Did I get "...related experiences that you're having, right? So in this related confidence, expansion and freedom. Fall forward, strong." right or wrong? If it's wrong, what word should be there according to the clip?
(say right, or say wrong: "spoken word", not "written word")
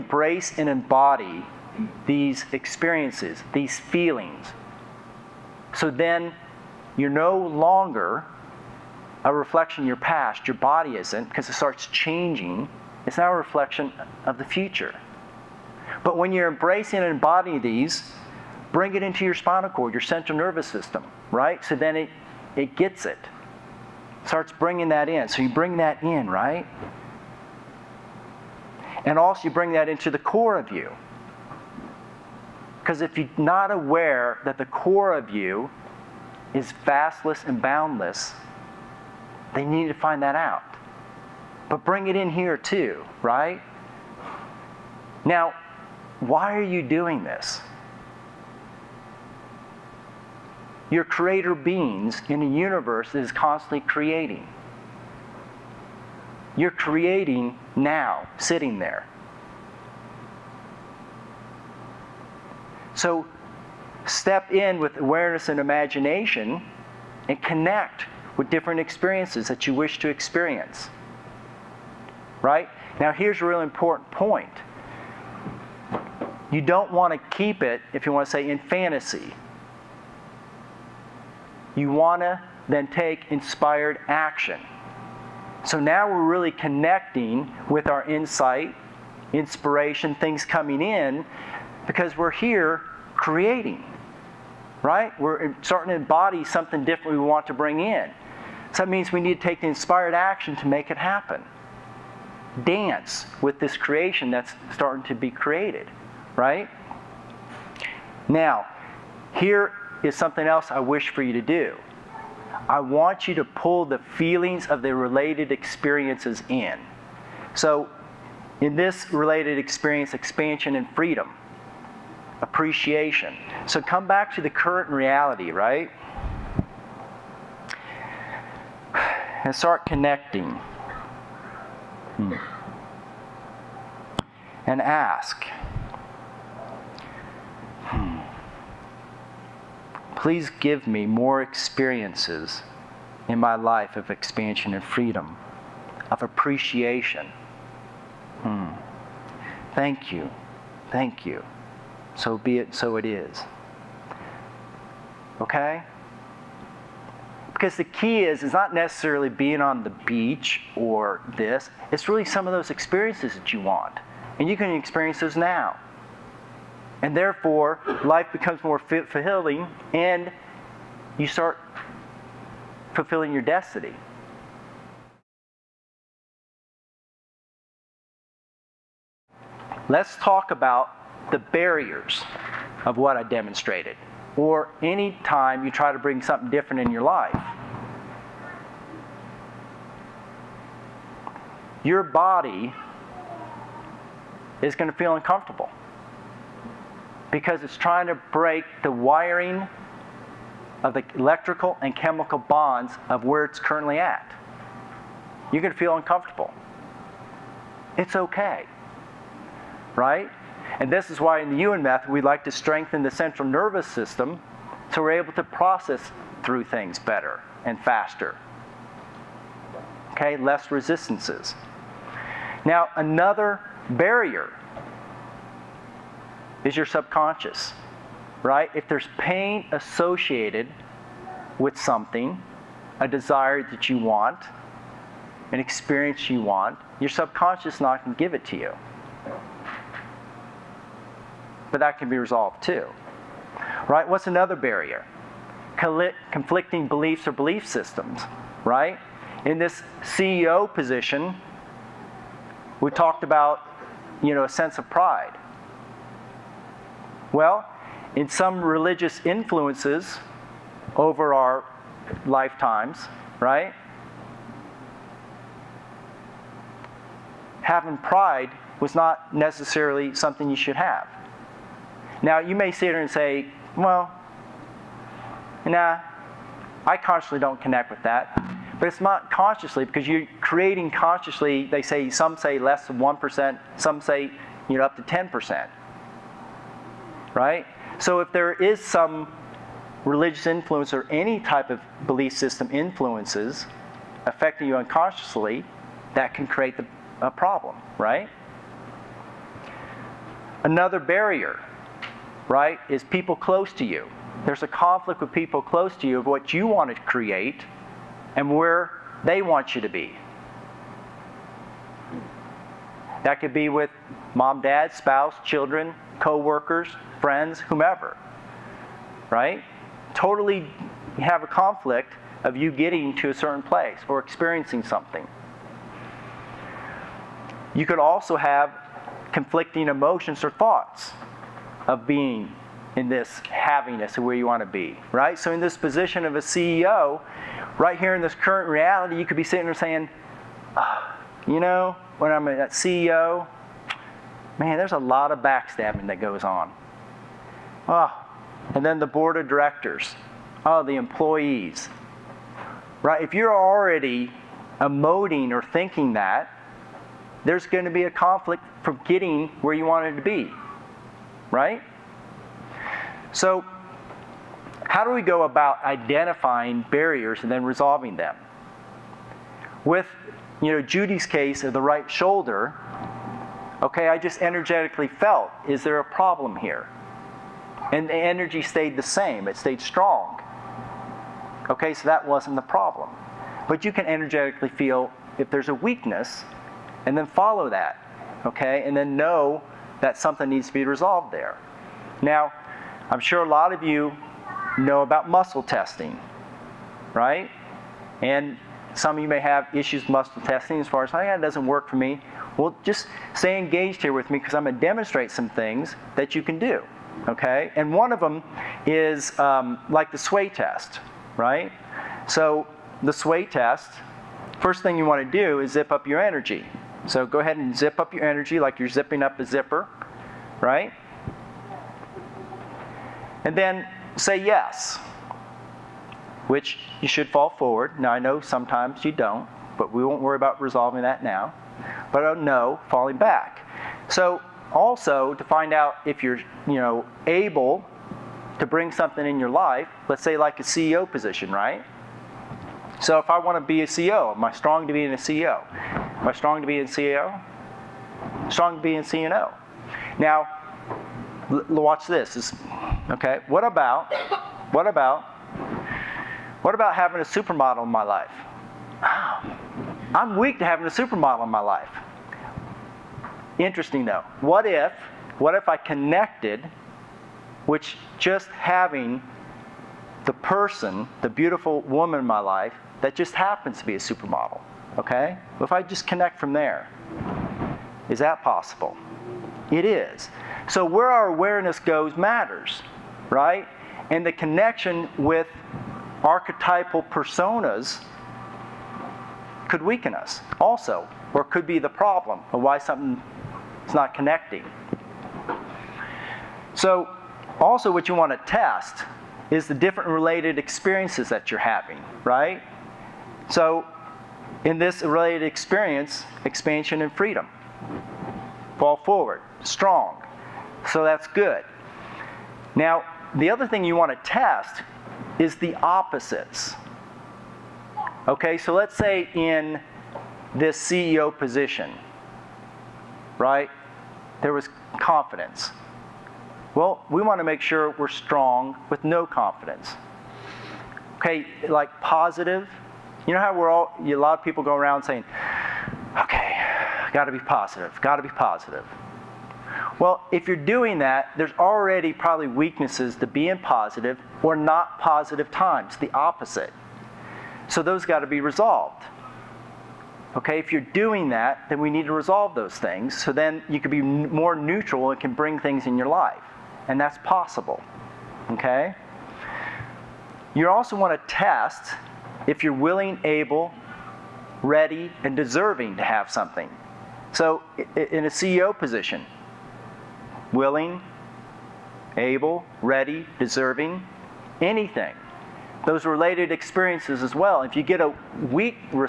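wrong: "experience", not "confidence".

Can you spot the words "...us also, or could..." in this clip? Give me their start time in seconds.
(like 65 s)
490 s.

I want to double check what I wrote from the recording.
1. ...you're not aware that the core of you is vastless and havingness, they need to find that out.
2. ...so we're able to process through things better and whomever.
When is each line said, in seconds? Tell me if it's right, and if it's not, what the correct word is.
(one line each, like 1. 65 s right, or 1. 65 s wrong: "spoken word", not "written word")
1. 33 s wrong: "boundless", not "havingness"
2. 214 s wrong: "faster", not "whomever".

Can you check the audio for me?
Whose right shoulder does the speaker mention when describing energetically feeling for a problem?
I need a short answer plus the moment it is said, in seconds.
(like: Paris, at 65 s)
Judy, at 370 s.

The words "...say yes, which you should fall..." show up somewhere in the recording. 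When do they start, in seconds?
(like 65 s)
424 s.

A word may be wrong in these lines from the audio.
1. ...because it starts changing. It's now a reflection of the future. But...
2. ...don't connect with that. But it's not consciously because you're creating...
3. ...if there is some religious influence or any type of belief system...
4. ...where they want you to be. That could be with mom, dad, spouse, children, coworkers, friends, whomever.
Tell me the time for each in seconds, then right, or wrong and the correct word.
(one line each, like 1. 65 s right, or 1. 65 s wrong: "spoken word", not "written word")
1. 11 s right
2. 277 s right
3. 288 s right
4. 308 s right.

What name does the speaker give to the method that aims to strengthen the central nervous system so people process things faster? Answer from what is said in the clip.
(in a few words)
Ewan method.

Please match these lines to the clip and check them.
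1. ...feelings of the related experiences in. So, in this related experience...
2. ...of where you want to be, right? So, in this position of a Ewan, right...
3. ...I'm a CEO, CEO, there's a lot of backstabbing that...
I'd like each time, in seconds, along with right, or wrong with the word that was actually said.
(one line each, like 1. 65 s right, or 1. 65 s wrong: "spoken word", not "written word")
1. 113 s right
2. 334 s wrong: "CEO", not "Ewan"
3. 342 s wrong: "Man", not "CEO".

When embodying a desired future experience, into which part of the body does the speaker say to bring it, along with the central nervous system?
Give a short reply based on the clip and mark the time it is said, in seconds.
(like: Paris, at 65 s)
Spinal cord, at 19 s.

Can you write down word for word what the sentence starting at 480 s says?
So where our awareness goes matters, right?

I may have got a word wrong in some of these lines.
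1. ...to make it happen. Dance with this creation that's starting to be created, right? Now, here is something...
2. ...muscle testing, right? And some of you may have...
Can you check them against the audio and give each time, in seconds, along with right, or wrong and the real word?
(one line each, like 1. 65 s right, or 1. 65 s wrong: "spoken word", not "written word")
1. 100 s right
2. 395 s right.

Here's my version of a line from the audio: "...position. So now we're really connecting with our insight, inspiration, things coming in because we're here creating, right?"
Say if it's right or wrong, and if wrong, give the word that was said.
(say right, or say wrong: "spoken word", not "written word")
wrong: "action", not "position".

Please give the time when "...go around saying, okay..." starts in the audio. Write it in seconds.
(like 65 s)
534 s.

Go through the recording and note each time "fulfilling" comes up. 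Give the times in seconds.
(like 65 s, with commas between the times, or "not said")
168 s, 172 s.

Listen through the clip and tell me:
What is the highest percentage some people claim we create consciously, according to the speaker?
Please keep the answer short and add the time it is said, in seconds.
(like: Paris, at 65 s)
10%, at 285 s.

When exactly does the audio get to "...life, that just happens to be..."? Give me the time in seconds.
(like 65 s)
472 s.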